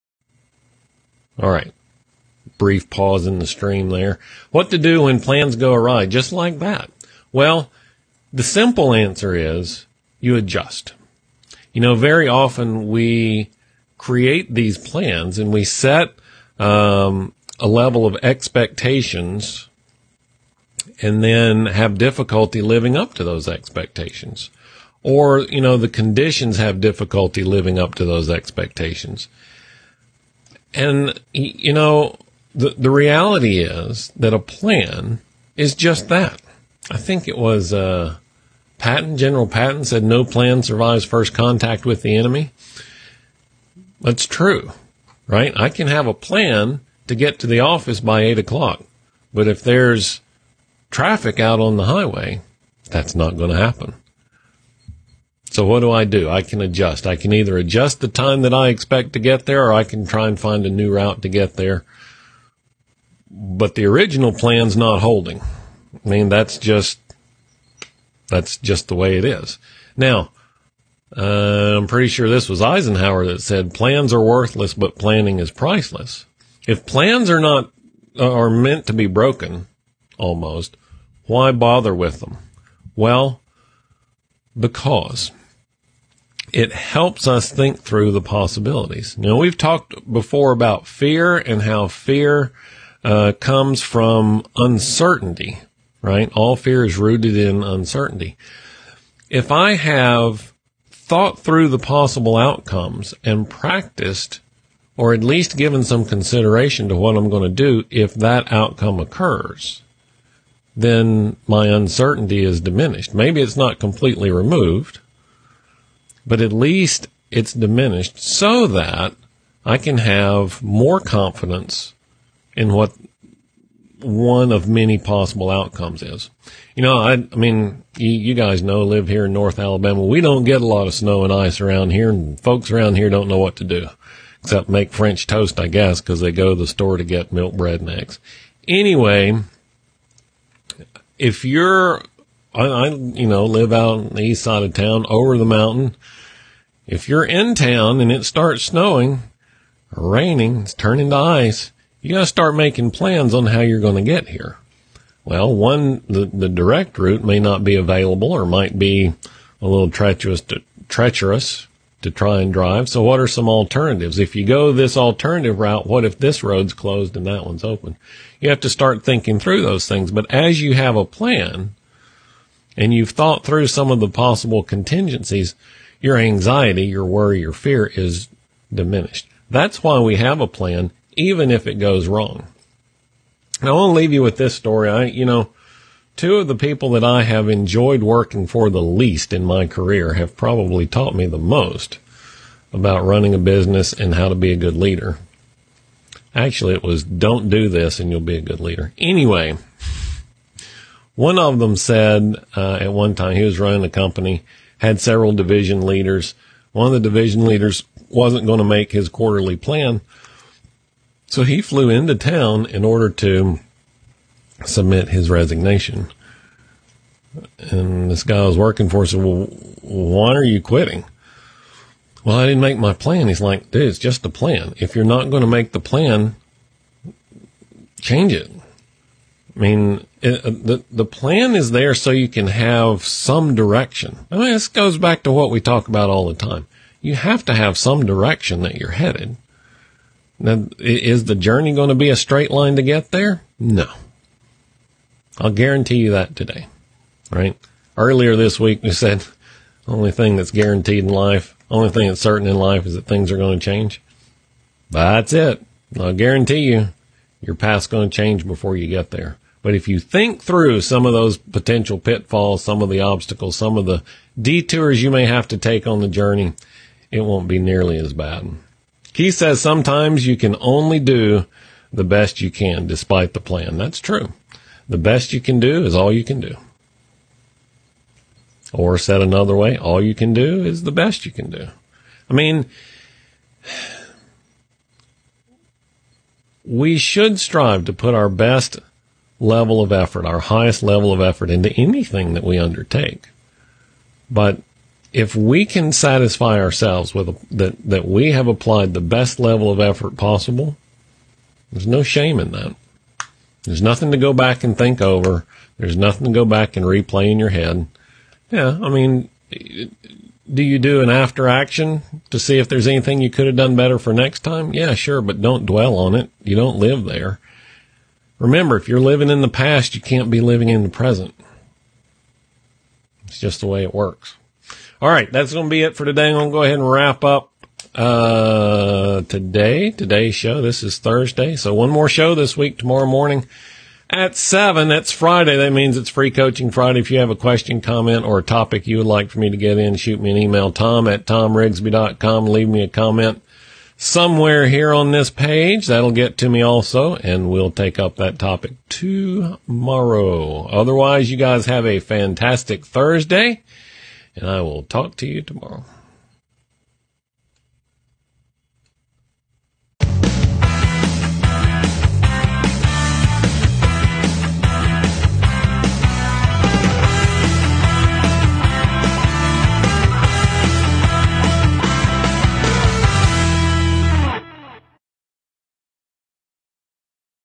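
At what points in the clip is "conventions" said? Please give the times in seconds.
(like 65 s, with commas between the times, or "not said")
not said.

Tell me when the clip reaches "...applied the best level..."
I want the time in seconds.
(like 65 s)
298 s.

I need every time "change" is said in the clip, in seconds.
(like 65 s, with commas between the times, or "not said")
228 s, 253 s, 258 s.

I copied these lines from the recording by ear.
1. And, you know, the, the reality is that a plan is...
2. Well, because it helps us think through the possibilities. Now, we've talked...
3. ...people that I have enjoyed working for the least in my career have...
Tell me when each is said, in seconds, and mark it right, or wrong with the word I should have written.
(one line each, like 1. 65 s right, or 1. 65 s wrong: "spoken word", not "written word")
1. 30 s right
2. 82 s right
3. 186 s right.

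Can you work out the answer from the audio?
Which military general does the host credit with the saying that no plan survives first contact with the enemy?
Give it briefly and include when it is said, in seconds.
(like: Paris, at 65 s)
General Patton, at 39 s.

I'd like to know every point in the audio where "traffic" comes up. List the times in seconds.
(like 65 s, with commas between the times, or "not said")
50 s.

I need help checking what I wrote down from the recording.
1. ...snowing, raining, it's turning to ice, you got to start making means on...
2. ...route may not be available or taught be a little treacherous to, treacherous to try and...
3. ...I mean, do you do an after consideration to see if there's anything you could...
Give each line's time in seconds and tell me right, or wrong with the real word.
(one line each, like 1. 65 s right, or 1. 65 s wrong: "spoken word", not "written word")
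1. 148 s wrong: "plans", not "means"
2. 156 s wrong: "might", not "taught"
3. 308 s wrong: "action", not "consideration".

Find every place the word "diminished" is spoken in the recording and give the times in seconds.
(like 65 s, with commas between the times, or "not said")
112 s, 117 s, 178 s.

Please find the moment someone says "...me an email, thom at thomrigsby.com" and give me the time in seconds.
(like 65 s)
340 s.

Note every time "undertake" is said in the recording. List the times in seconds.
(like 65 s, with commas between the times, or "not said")
292 s.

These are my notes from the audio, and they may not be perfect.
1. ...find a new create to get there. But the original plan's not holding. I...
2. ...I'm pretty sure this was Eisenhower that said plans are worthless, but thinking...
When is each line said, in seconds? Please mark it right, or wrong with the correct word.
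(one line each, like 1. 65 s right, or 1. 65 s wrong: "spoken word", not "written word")
1. 60 s wrong: "route", not "create"
2. 71 s wrong: "planning", not "thinking".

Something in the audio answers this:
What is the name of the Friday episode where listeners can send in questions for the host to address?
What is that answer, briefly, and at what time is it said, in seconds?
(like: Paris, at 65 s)
Free coaching Friday, at 336 s.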